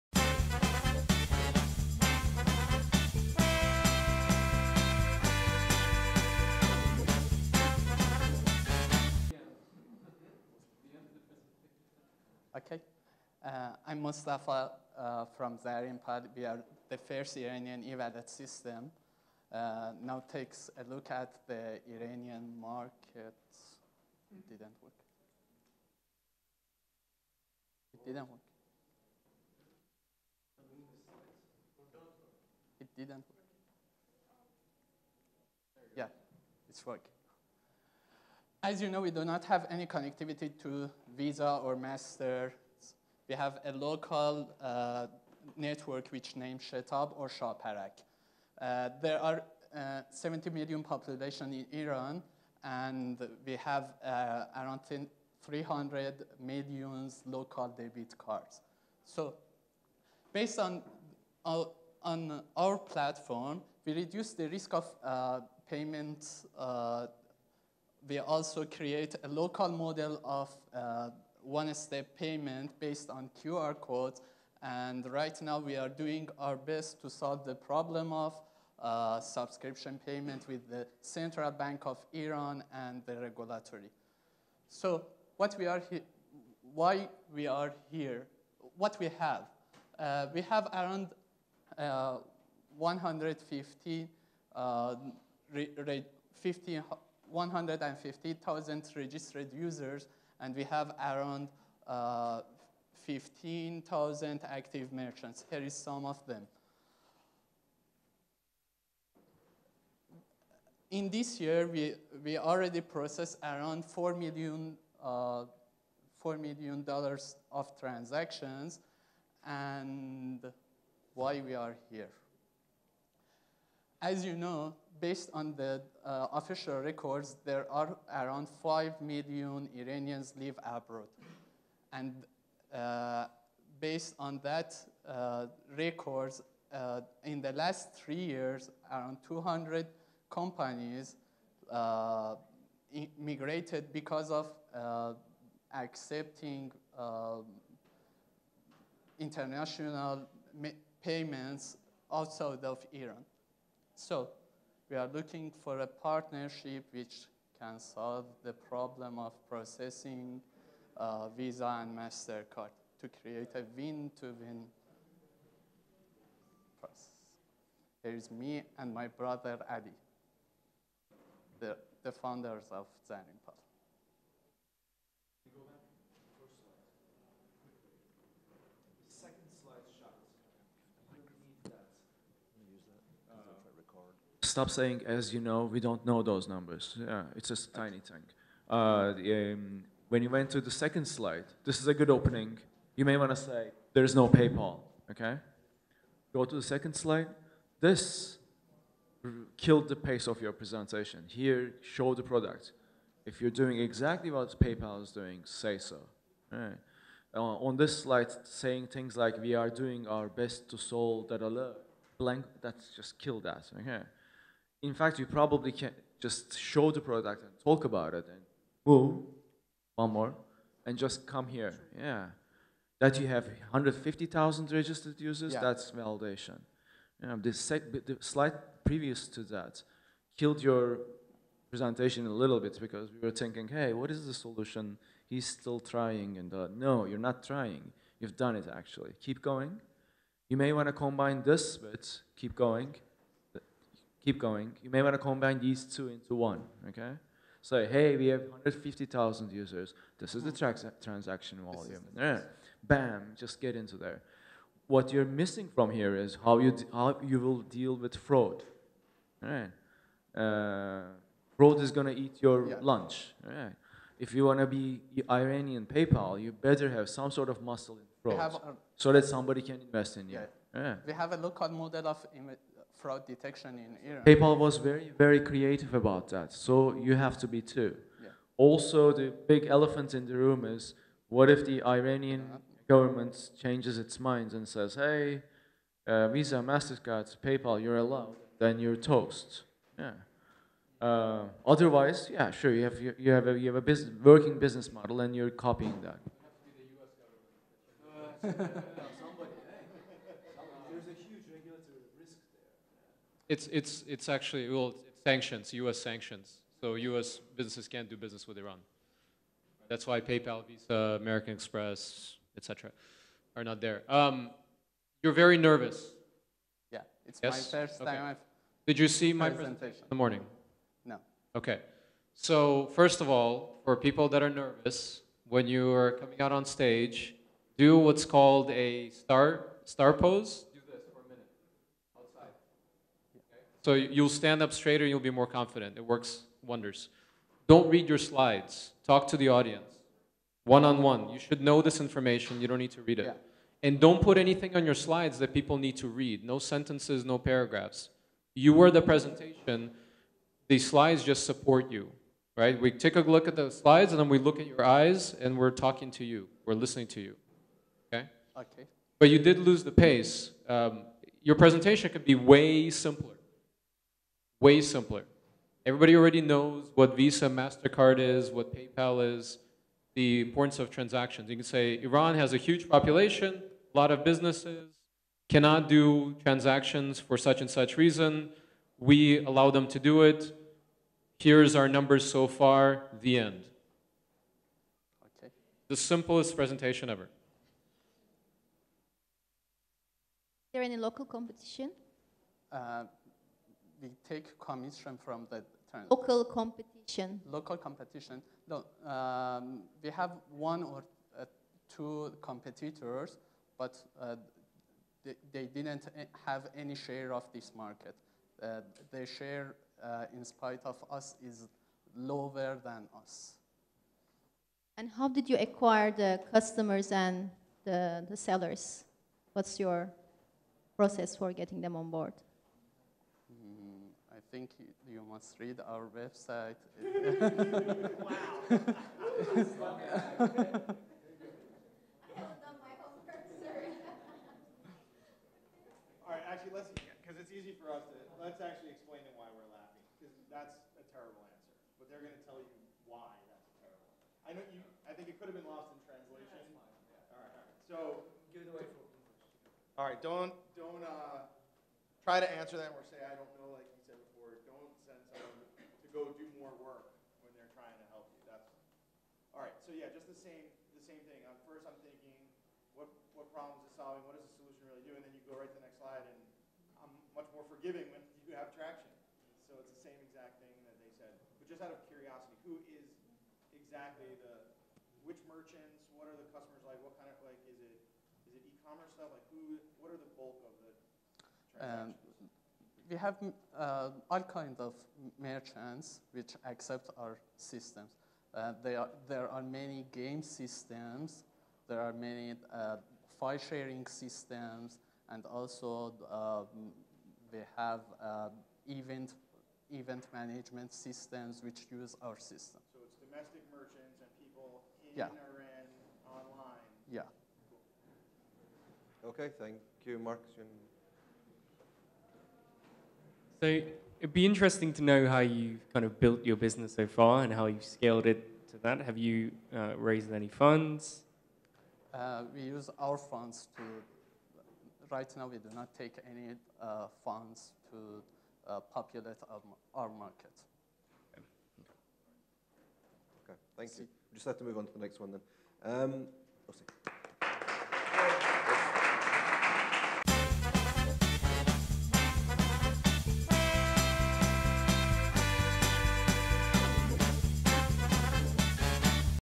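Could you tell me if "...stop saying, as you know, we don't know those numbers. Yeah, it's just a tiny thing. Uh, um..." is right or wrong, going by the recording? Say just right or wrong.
right.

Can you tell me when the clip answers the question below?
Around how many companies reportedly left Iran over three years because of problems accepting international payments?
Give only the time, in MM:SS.
02:19.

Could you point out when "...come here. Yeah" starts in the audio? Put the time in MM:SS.
03:41.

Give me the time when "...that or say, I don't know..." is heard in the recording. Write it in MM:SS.
07:32.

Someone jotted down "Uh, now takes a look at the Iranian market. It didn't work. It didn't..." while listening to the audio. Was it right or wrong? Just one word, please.
right.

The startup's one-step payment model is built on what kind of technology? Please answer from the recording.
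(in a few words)
QR codes.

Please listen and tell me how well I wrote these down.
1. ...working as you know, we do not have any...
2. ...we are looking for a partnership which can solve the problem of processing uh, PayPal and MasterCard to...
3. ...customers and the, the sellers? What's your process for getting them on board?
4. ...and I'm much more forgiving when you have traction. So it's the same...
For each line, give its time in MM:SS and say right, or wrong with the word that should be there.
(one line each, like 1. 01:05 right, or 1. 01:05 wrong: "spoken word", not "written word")
1. 00:36 right
2. 02:34 wrong: "Visa", not "PayPal"
3. 06:56 right
4. 07:46 right.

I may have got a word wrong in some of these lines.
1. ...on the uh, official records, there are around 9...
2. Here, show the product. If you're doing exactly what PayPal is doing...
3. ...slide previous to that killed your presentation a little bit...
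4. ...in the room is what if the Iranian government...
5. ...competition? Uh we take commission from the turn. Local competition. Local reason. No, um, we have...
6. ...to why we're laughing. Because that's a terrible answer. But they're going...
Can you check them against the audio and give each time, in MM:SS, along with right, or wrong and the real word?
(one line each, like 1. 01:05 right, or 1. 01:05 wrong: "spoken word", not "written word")
1. 02:05 wrong: "5", not "9"
2. 03:21 right
3. 03:48 right
4. 04:40 right
5. 06:31 wrong: "competition", not "reason"
6. 07:19 right.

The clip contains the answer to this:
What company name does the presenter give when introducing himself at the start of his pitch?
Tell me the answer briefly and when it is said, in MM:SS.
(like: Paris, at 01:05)
ZarinPal, at 00:15.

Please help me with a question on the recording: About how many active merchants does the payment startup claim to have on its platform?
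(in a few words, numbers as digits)
15,000.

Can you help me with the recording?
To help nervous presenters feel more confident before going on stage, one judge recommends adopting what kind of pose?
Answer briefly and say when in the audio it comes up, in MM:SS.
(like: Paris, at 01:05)
star pose, at 05:29.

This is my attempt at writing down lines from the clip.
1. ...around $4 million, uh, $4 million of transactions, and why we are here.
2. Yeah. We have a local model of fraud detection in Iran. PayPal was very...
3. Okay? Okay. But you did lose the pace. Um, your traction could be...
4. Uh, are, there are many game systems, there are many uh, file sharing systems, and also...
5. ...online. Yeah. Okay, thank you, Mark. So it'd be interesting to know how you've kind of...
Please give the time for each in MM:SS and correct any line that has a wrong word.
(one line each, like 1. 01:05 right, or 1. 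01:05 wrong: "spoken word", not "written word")
1. 01:53 right
2. 04:30 right
3. 05:58 wrong: "presentation", not "traction"
4. 08:08 right
5. 08:26 right.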